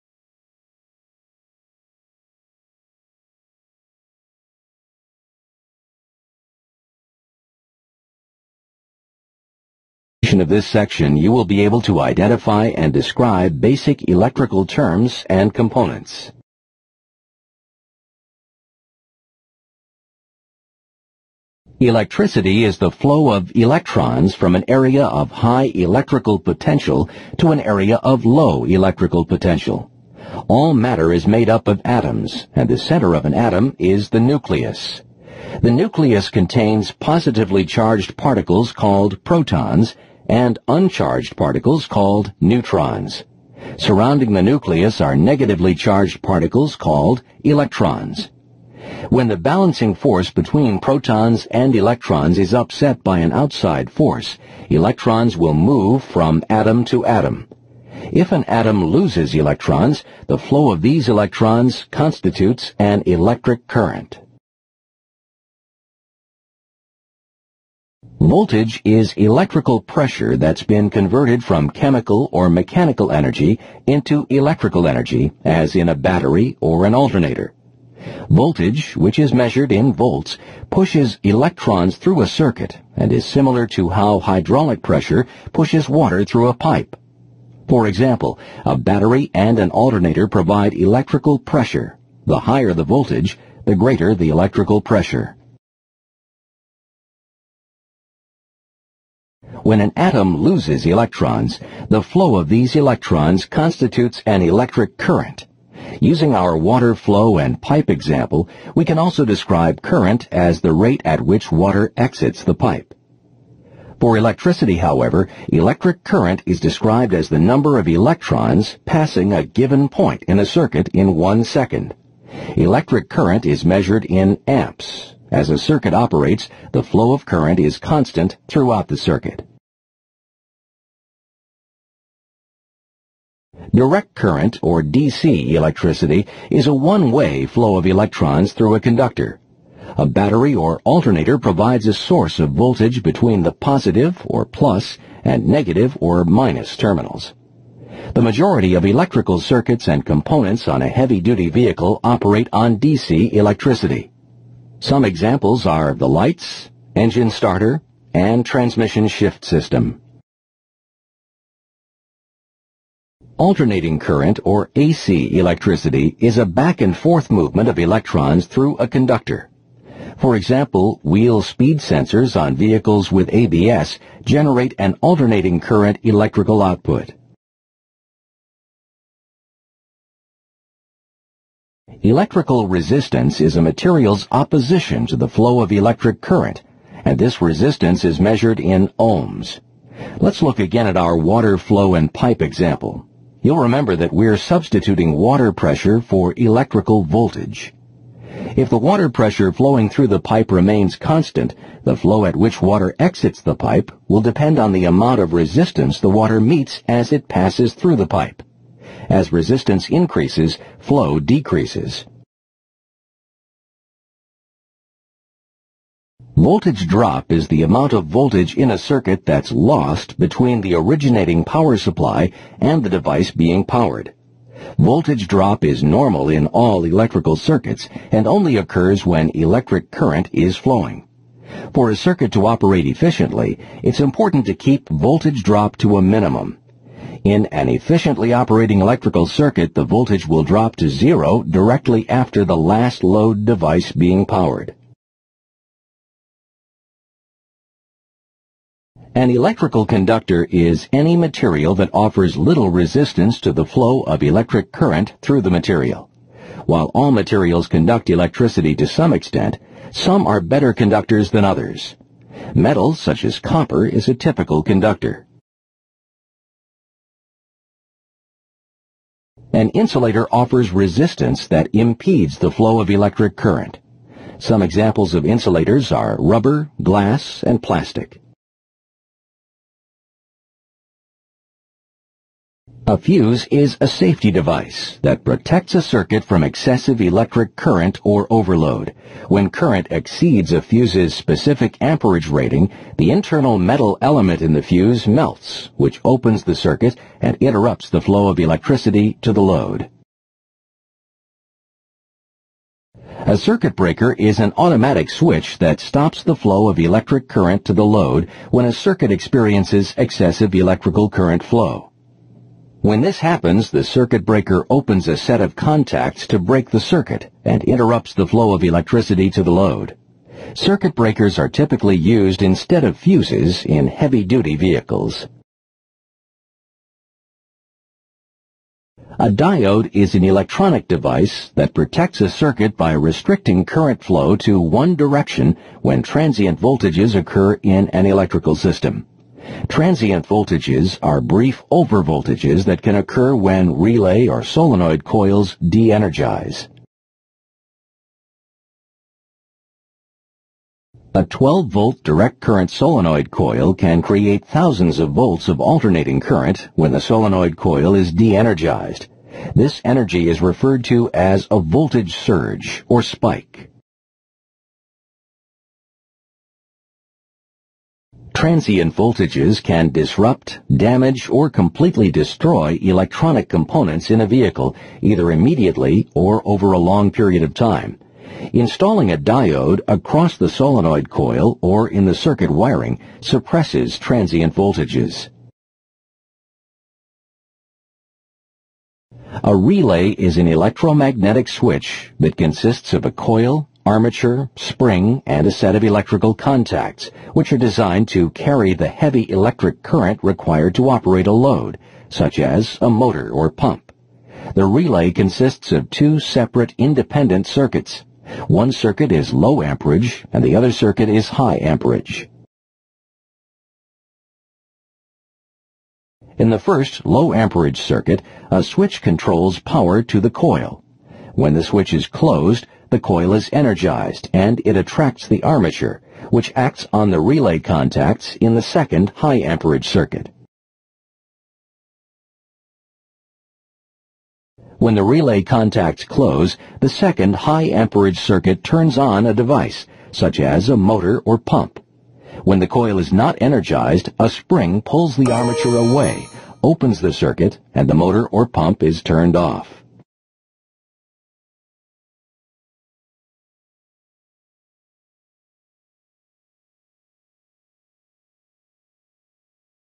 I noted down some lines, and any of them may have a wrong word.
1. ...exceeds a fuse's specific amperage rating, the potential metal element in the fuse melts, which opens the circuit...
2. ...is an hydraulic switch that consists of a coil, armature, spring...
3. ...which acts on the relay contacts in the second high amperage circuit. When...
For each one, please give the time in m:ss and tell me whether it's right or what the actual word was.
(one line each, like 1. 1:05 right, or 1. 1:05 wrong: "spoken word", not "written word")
1. 4:49 wrong: "internal", not "potential"
2. 6:30 wrong: "electromagnetic", not "hydraulic"
3. 7:06 right.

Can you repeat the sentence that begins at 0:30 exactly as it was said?
All matter is made up of atoms, and the center of an atom is the nucleus.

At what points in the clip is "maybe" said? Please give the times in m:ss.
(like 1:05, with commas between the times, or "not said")
not said.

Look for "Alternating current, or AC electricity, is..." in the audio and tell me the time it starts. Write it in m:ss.
2:43.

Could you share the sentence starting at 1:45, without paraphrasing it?
Using our water flow and pipe example, we can also describe current as the rate at which water exits the pipe.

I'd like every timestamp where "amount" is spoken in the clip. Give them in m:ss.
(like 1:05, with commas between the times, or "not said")
3:24, 3:37.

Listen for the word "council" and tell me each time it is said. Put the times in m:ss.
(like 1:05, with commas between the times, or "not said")
not said.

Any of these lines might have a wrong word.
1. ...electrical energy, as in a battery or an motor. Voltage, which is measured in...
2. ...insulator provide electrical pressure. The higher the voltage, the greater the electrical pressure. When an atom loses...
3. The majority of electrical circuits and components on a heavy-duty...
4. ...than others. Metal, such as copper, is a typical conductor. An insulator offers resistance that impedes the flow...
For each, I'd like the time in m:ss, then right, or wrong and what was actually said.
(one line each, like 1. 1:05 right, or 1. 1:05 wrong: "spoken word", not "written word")
1. 1:14 wrong: "alternator", not "motor"
2. 1:29 wrong: "alternator", not "insulator"
3. 2:28 right
4. 4:21 right.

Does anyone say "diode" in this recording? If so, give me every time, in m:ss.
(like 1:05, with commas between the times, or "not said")
5:29, 6:19.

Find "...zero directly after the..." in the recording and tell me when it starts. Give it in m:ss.
4:00.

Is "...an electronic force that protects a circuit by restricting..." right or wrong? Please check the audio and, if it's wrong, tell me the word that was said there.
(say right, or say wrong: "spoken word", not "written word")
wrong: "device", not "force".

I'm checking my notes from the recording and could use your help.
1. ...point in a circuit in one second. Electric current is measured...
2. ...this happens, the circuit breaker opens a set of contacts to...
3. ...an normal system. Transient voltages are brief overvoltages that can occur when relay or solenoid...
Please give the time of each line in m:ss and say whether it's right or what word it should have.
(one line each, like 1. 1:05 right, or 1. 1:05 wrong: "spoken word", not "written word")
1. 1:59 right
2. 5:13 right
3. 5:37 wrong: "electrical", not "normal".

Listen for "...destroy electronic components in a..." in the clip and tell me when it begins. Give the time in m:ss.
6:12.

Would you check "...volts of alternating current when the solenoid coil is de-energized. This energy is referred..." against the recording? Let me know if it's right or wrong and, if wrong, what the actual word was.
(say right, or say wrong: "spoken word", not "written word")
right.